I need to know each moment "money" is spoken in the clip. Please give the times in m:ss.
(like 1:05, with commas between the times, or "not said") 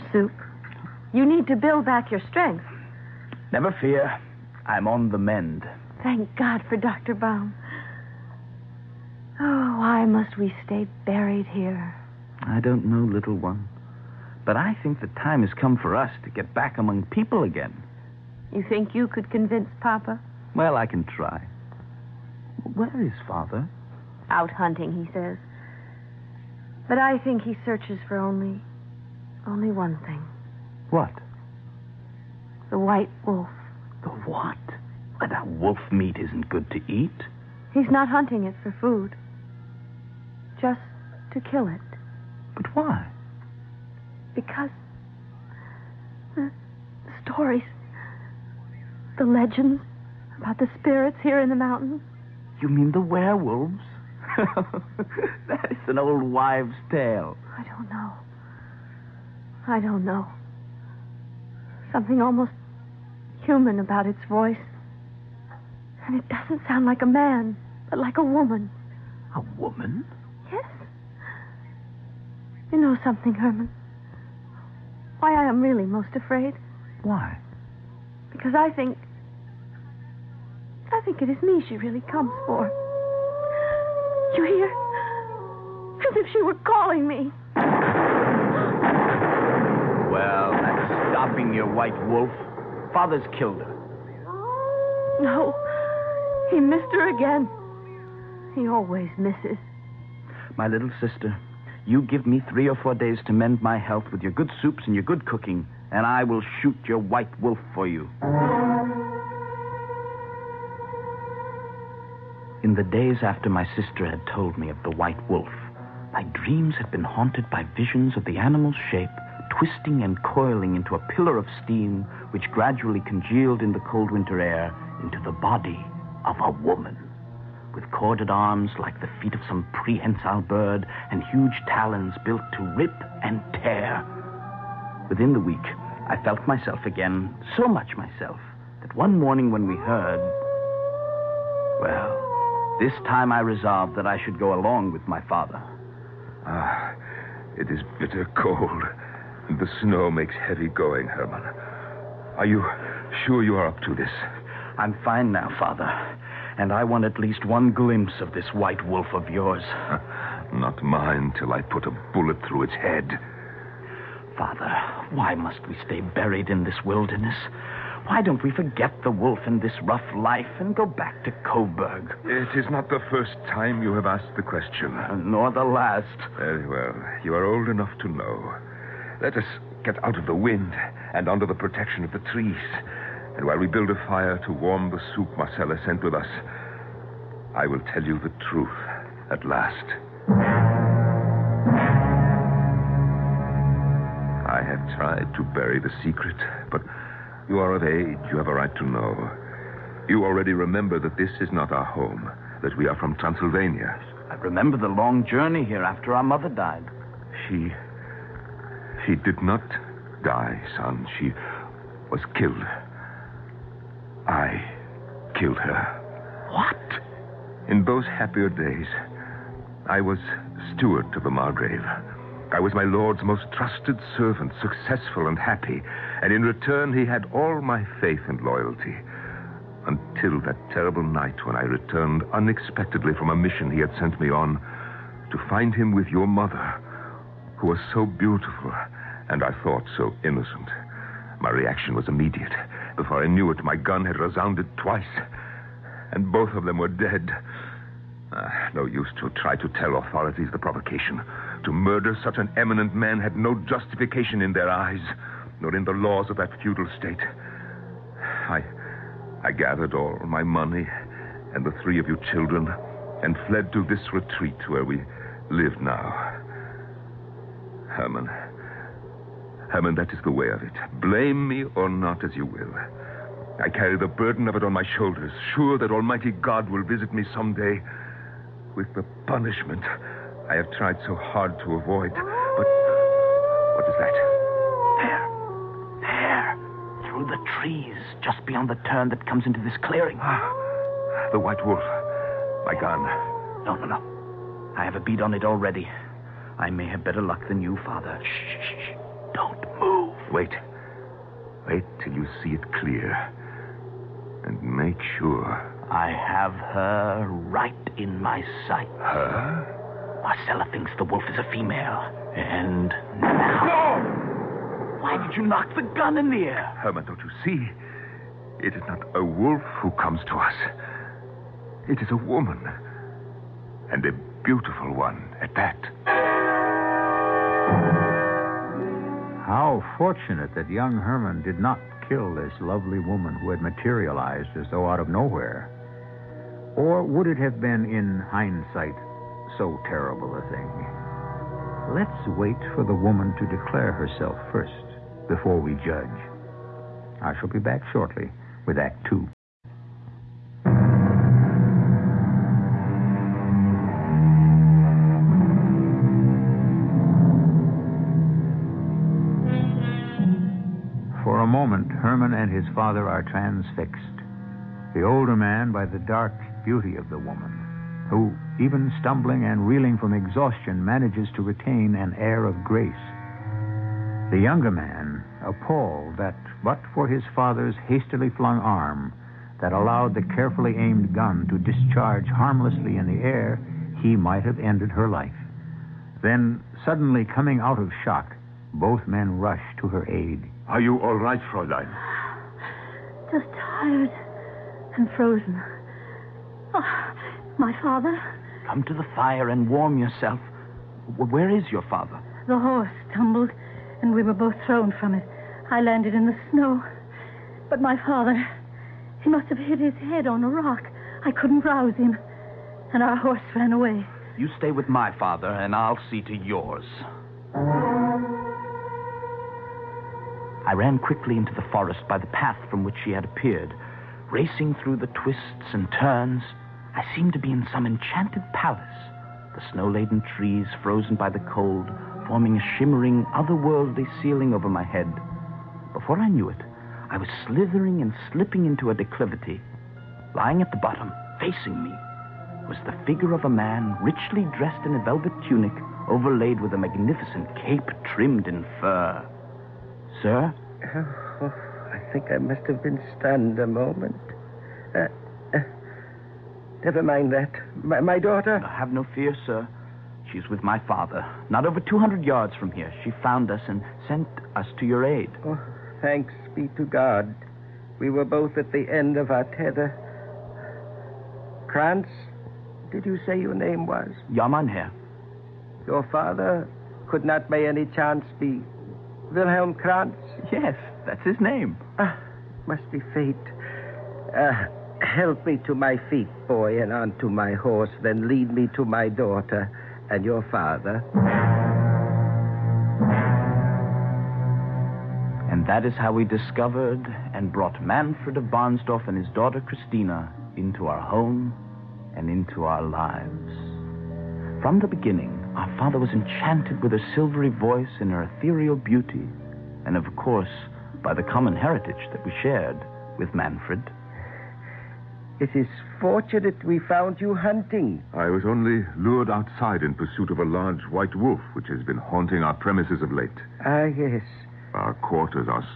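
4:20.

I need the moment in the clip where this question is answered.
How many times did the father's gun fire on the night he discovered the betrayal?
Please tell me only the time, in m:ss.
4:04.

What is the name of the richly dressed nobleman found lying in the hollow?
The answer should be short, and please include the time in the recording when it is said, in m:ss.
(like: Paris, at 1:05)
Manfred of Barnsdorf, at 8:17.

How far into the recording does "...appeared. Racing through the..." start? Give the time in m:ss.
7:03.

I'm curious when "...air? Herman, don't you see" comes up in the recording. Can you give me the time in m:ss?
5:16.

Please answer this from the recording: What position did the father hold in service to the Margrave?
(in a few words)
Steward.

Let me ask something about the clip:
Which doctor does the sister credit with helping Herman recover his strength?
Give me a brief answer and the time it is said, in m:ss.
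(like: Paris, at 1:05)
Dr. Baum, at 0:06.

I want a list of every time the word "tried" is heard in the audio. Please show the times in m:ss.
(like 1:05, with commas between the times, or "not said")
3:14, 4:40.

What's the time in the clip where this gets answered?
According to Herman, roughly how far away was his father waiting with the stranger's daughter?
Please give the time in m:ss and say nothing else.
7:41.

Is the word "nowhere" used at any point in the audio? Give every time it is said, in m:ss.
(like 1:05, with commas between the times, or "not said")
5:35.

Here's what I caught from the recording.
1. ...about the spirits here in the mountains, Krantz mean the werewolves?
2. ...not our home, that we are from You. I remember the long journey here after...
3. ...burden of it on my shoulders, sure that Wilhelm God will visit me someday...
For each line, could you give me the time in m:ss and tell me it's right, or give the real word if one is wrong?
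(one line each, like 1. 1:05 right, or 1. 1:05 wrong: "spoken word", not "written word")
1. 0:50 wrong: "You", not "Krantz"
2. 3:21 wrong: "Transylvania", not "You"
3. 4:34 wrong: "Almighty", not "Wilhelm".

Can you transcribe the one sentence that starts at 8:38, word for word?
I was only lured outside in pursuit of a large white wolf, which has been haunting our premises of late.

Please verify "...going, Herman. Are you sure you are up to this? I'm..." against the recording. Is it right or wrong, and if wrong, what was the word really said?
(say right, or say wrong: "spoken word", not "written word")
right.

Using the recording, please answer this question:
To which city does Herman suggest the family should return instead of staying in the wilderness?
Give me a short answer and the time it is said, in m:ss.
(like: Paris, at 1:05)
Coburg, at 2:51.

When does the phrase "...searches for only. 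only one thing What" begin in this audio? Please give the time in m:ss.
0:27.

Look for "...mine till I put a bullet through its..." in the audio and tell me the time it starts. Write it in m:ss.
2:40.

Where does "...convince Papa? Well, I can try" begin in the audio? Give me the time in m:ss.
0:19.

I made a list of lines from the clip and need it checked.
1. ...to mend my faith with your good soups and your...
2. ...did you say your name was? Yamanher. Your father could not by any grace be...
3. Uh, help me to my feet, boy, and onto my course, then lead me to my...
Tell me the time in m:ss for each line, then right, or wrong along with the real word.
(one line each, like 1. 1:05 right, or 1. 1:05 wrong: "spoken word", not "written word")
1. 1:43 wrong: "health", not "faith"
2. 7:52 wrong: "chance", not "grace"
3. 8:04 wrong: "horse", not "course".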